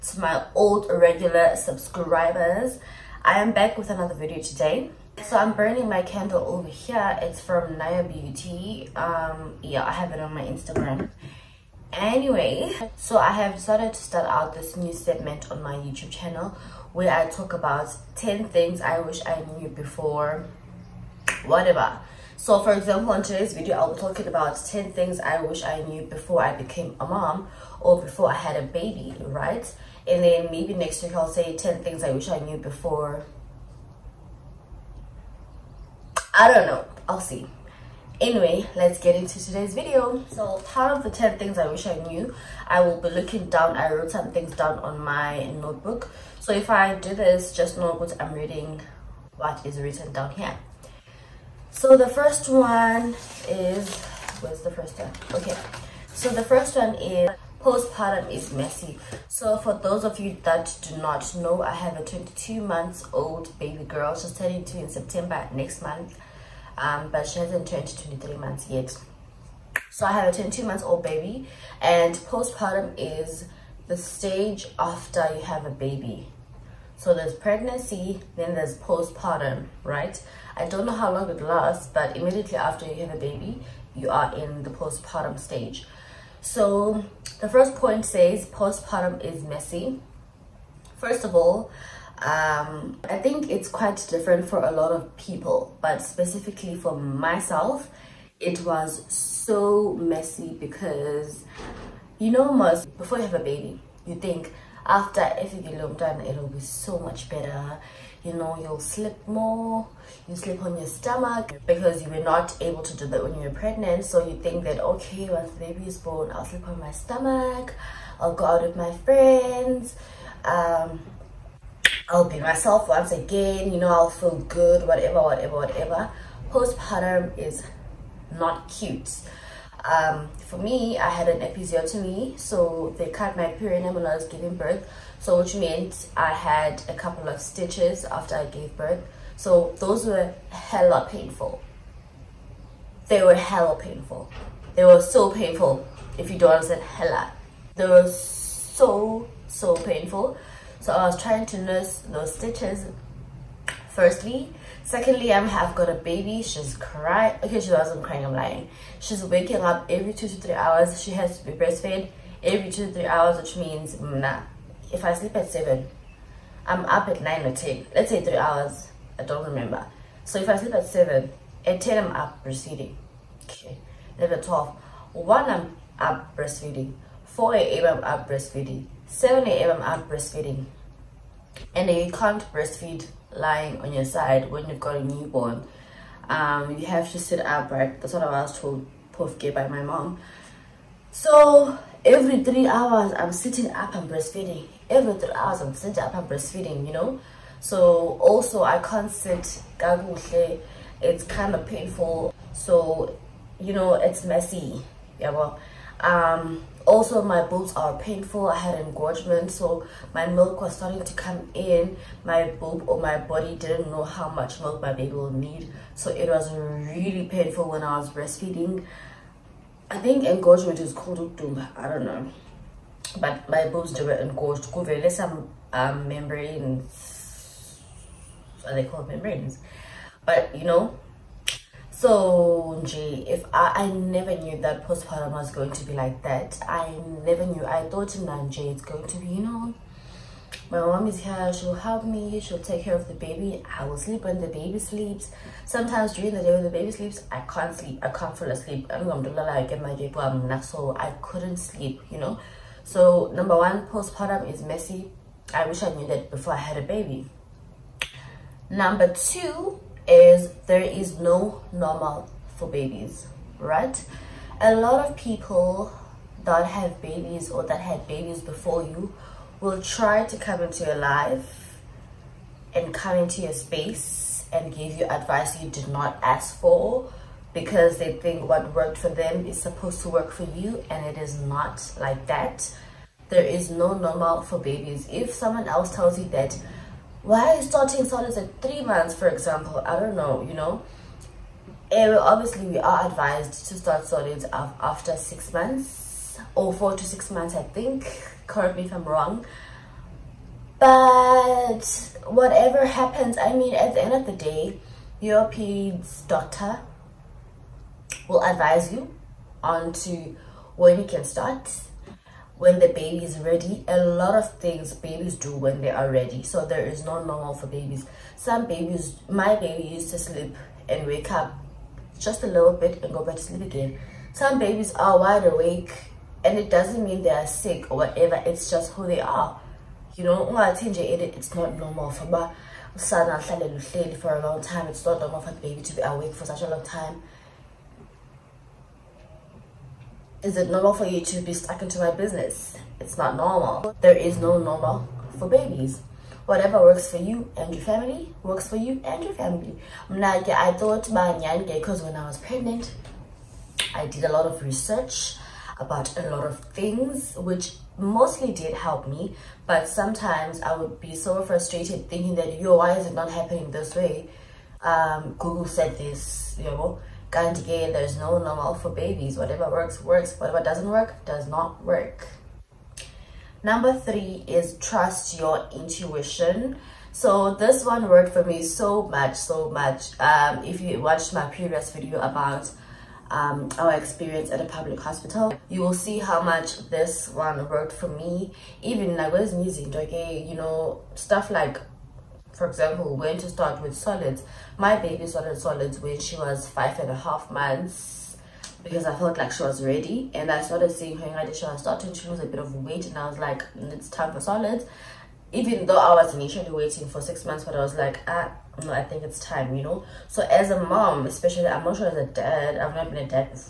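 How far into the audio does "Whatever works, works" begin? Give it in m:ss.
6:09.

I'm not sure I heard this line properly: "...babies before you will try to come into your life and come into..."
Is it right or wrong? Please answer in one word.
right.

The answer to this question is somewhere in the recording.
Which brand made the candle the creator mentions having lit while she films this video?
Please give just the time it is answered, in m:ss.
0:07.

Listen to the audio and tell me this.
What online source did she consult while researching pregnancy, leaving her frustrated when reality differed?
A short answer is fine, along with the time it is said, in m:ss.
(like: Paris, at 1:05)
Google, at 6:05.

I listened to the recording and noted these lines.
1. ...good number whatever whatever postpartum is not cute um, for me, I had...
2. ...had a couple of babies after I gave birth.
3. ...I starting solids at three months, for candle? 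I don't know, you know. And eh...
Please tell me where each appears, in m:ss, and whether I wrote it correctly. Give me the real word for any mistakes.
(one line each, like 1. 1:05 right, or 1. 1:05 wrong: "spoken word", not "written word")
1. 2:04 wrong: "whatever", not "number"
2. 2:16 wrong: "stitches", not "babies"
3. 4:47 wrong: "example", not "candle".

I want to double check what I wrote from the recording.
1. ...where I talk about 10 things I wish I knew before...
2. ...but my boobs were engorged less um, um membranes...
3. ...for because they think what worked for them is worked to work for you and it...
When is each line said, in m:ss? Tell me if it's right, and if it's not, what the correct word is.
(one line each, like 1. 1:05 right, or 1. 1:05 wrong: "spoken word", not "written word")
1. 0:16 right
2. 3:43 right
3. 4:36 wrong: "supposed", not "worked".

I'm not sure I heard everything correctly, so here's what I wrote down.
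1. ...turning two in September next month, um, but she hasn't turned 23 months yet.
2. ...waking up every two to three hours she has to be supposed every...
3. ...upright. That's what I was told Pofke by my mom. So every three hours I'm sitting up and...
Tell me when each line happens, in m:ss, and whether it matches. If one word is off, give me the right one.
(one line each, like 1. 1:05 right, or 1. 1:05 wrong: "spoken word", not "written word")
1. 1:04 right
2. 2:39 wrong: "breastfed", not "supposed"
3. 3:07 right.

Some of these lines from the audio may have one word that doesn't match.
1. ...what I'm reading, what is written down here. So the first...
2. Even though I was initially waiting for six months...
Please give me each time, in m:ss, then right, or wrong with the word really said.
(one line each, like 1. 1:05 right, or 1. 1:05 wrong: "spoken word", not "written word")
1. 0:47 right
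2. 6:45 right.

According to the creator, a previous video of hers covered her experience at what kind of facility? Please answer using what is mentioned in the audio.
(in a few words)
Public hospital.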